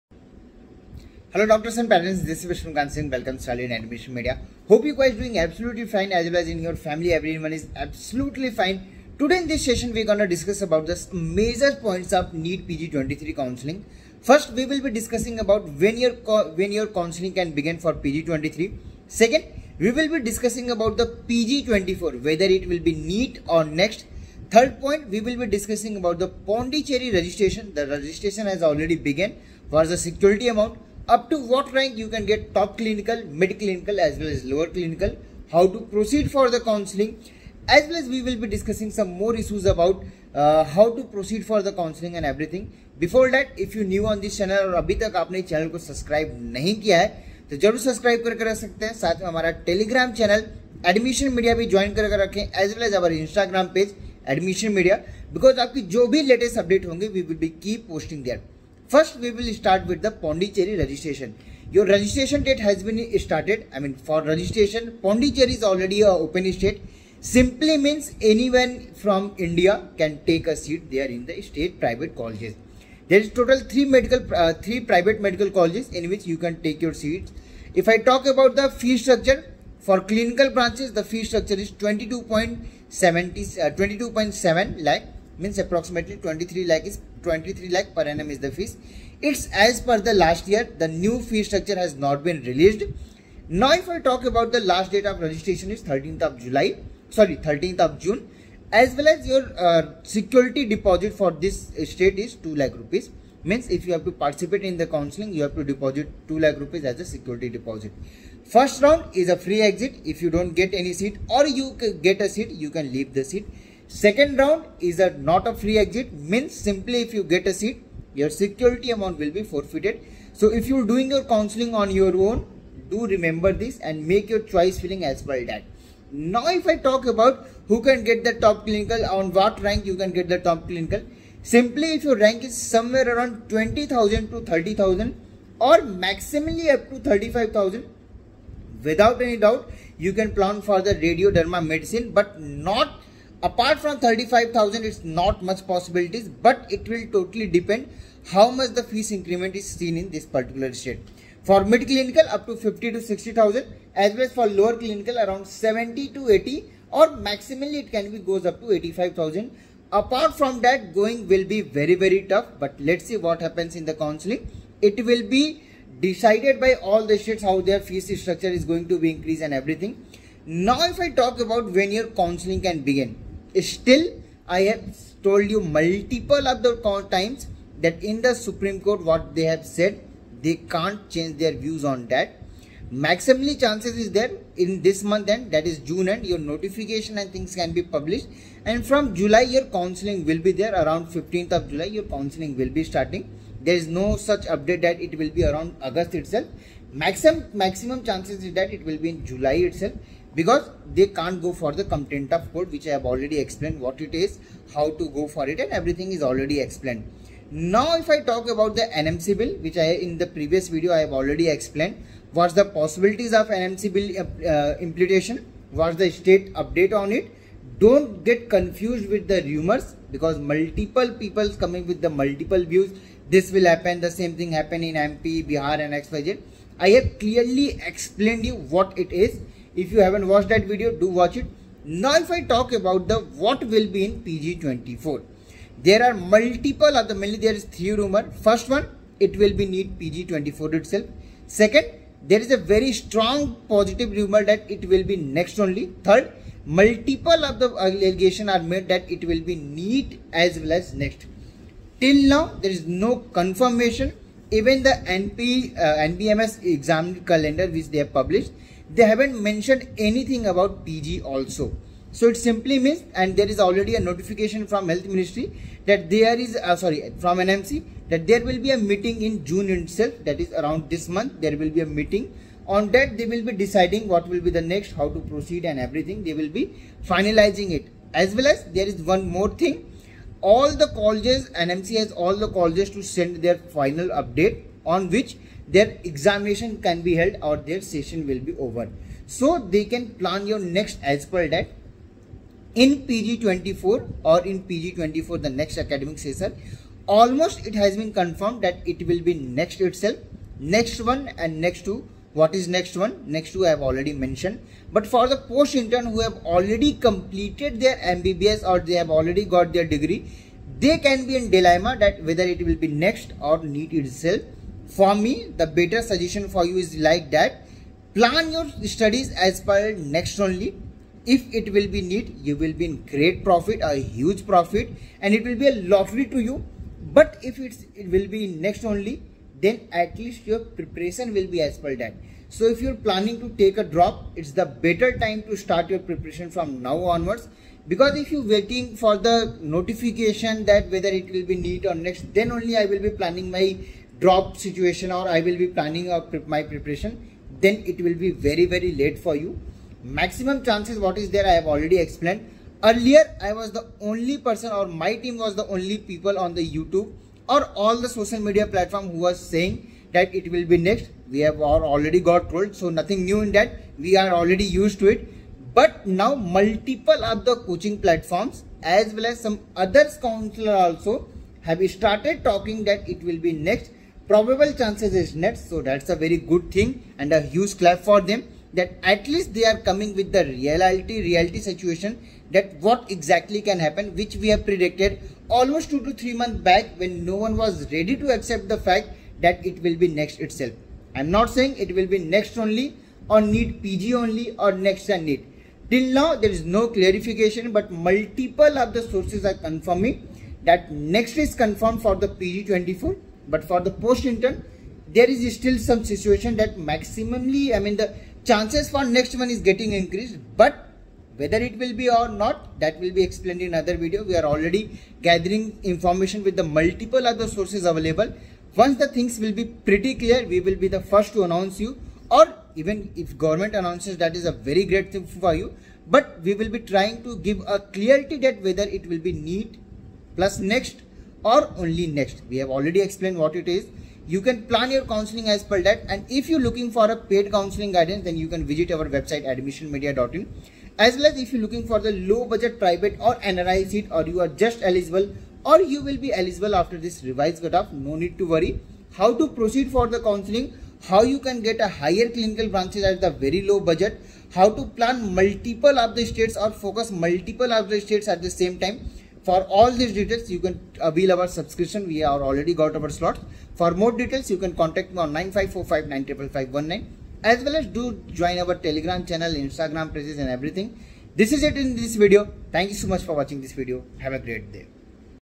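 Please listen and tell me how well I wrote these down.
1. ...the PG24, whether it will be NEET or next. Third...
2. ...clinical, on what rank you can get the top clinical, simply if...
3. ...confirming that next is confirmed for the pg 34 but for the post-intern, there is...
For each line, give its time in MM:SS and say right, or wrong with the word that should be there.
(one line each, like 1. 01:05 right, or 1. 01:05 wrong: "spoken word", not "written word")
1. 00:20 right
2. 02:08 right
3. 06:39 wrong: "24", not "34".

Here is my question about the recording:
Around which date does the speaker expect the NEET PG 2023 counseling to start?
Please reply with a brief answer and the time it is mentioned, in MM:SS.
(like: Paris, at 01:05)
15th of July, at 03:11.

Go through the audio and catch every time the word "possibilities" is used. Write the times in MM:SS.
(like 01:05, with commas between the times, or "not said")
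02:25, 03:32.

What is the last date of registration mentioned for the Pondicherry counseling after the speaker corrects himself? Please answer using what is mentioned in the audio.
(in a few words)
13th of June.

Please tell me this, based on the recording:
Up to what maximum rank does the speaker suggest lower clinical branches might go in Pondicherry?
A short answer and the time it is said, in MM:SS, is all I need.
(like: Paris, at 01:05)
85,000, at 02:38.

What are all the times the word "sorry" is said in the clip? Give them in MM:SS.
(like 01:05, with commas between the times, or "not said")
01:37, 04:26.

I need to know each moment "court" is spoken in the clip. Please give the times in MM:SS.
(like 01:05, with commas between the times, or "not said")
02:58, 03:22.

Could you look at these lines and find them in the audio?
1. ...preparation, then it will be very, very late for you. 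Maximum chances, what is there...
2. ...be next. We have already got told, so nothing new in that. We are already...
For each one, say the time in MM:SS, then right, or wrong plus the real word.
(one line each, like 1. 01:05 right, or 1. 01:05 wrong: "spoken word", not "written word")
1. 05:46 right
2. 06:00 right.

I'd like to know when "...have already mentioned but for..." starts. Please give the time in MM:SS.
05:03.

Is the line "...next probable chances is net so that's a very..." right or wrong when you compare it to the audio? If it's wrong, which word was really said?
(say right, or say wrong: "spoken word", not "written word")
right.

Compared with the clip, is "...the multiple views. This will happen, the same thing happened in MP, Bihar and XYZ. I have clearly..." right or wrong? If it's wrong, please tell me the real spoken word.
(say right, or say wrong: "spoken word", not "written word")
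right.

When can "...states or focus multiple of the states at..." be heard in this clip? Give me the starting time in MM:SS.
07:36.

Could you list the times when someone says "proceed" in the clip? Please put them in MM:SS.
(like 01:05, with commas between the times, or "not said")
04:35, 07:29.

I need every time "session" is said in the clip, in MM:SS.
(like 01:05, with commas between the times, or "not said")
00:09, 04:47, 04:56.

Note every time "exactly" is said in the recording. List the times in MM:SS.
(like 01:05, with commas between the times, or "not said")
06:23.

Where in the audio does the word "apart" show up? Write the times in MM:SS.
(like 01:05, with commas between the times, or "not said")
02:23, 02:39.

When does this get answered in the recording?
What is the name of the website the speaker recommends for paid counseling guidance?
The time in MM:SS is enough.
07:19.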